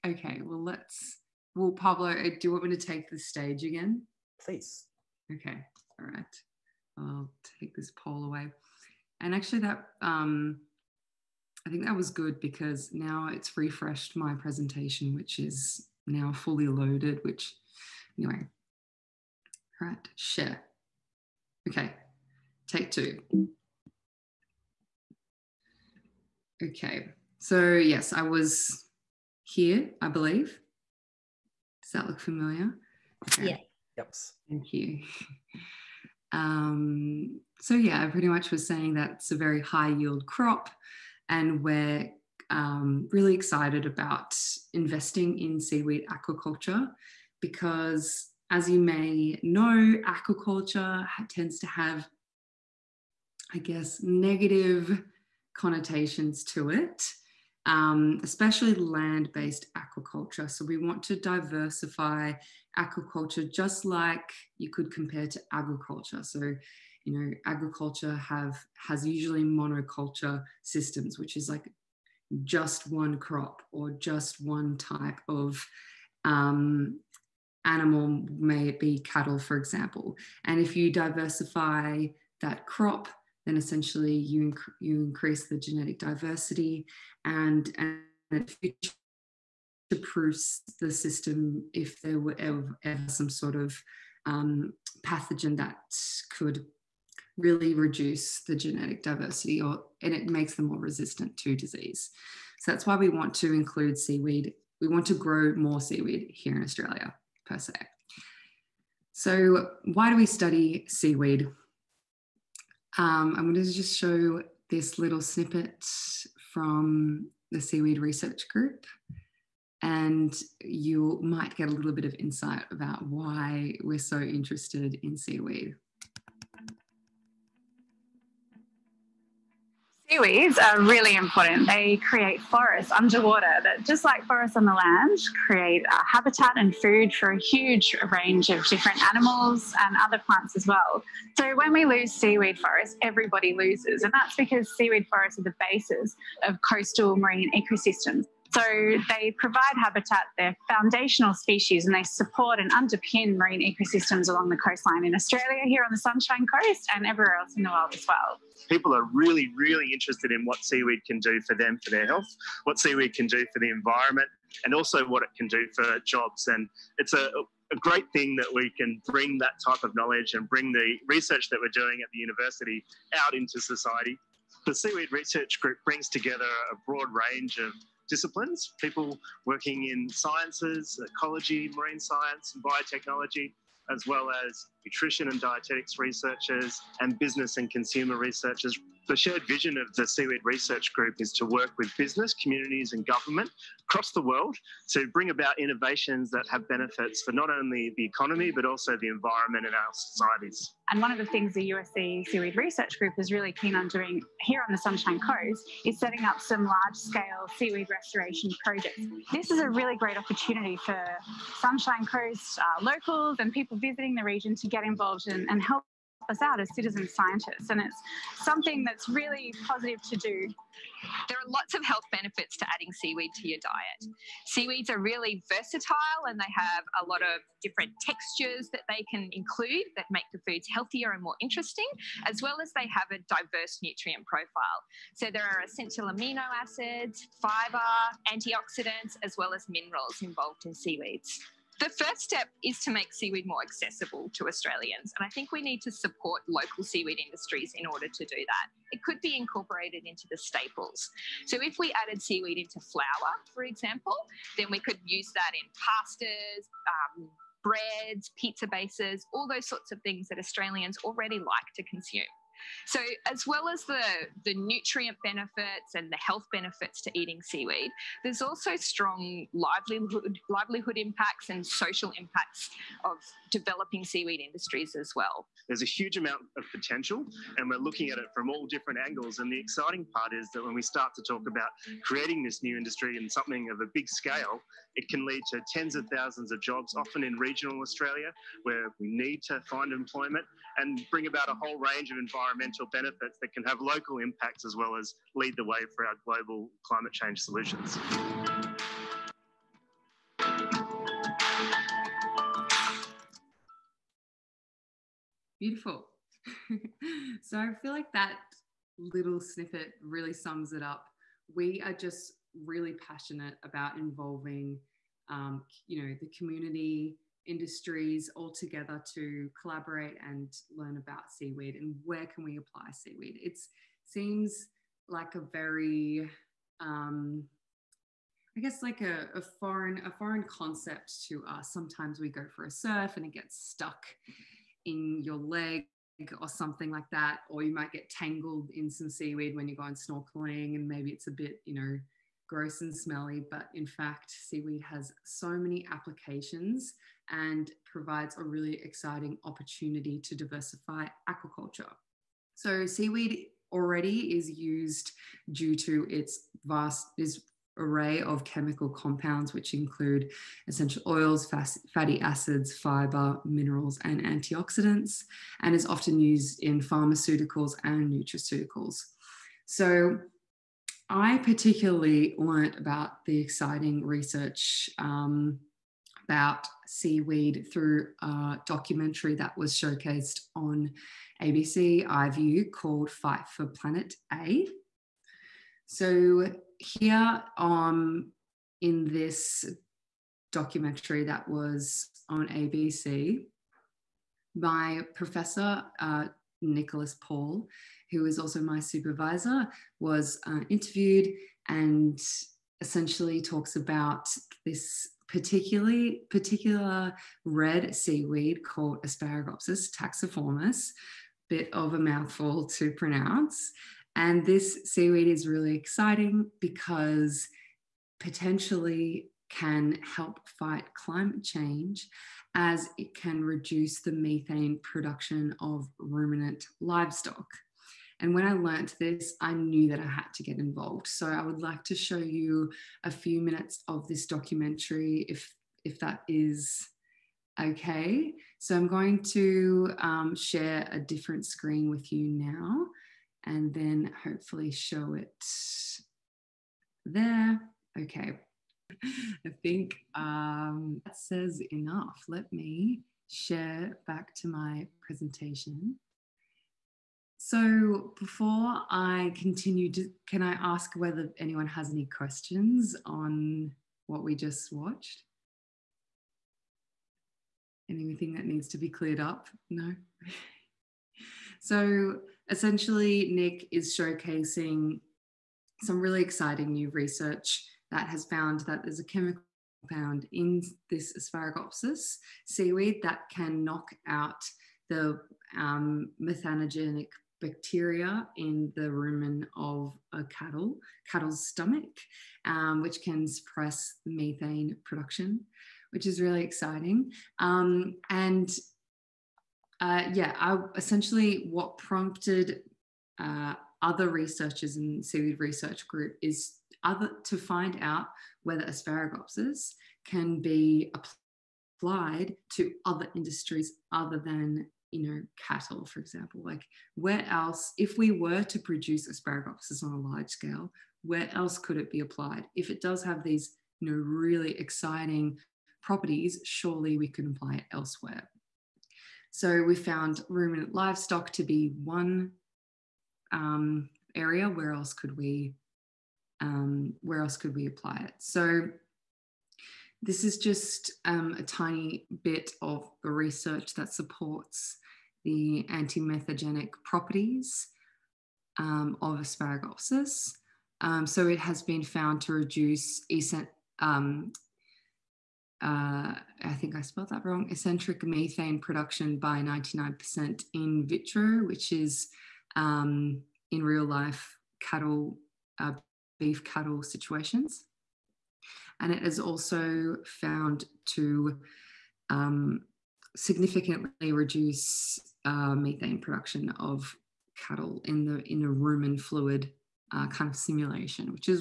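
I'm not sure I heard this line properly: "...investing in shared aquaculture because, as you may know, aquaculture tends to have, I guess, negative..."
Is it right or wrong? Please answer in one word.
wrong.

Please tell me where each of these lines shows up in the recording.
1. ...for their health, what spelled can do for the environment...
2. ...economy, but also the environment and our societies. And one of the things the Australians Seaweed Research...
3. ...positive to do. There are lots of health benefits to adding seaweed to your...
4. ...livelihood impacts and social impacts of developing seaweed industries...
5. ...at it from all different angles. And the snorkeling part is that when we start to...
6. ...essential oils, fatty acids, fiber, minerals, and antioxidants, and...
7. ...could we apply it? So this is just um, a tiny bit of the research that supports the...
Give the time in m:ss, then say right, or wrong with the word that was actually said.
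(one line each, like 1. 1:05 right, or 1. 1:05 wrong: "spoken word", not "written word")
1. 2:41 wrong: "seaweed", not "spelled"
2. 3:18 wrong: "USC", not "Australians"
3. 3:39 right
4. 4:30 right
5. 4:38 wrong: "exciting", not "snorkeling"
6. 6:00 right
7. 8:57 right.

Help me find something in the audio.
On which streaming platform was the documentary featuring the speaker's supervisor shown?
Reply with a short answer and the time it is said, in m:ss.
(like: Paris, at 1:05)
ABC iView, at 6:21.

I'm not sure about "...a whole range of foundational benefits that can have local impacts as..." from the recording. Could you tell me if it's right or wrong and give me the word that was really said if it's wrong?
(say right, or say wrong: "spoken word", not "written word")
wrong: "environmental", not "foundational".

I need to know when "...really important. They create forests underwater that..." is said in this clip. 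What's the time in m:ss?
2:10.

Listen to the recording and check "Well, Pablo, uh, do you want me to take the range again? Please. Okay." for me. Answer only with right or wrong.
wrong.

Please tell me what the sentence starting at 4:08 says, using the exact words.
It could be incorporated into the staples.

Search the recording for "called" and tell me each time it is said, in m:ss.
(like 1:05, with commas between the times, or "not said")
6:22, 6:48.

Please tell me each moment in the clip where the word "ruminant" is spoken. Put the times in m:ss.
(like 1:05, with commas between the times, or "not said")
7:05, 8:50.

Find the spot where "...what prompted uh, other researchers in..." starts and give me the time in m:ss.
8:21.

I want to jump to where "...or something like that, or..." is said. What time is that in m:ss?
5:36.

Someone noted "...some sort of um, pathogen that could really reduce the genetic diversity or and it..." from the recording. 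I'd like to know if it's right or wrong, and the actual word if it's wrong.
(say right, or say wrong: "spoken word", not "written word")
right.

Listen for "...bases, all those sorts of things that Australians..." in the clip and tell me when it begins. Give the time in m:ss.
4:18.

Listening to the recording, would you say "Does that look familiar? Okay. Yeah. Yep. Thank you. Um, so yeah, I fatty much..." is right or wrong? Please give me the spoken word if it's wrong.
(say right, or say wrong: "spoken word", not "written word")
wrong: "pretty", not "fatty".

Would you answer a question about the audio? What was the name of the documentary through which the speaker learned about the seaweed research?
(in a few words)
Fight for Planet A.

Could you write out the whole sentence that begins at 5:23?
It seems like a very, um, I guess, like a, a foreign a foreign concept to us.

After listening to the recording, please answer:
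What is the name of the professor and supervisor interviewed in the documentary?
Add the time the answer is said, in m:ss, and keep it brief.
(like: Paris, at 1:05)
Nicholas Paul, at 6:36.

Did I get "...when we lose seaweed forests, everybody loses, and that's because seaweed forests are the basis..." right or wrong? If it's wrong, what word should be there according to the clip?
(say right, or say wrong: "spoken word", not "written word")
right.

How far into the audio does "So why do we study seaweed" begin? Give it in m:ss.
1:49.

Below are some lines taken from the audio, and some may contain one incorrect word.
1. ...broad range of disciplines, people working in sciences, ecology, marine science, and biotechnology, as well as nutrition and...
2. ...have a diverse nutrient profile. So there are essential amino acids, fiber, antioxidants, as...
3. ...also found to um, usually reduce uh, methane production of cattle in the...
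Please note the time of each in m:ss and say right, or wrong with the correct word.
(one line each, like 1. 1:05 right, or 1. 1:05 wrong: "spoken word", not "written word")
1. 2:56 right
2. 3:52 right
3. 9:29 wrong: "significantly", not "usually".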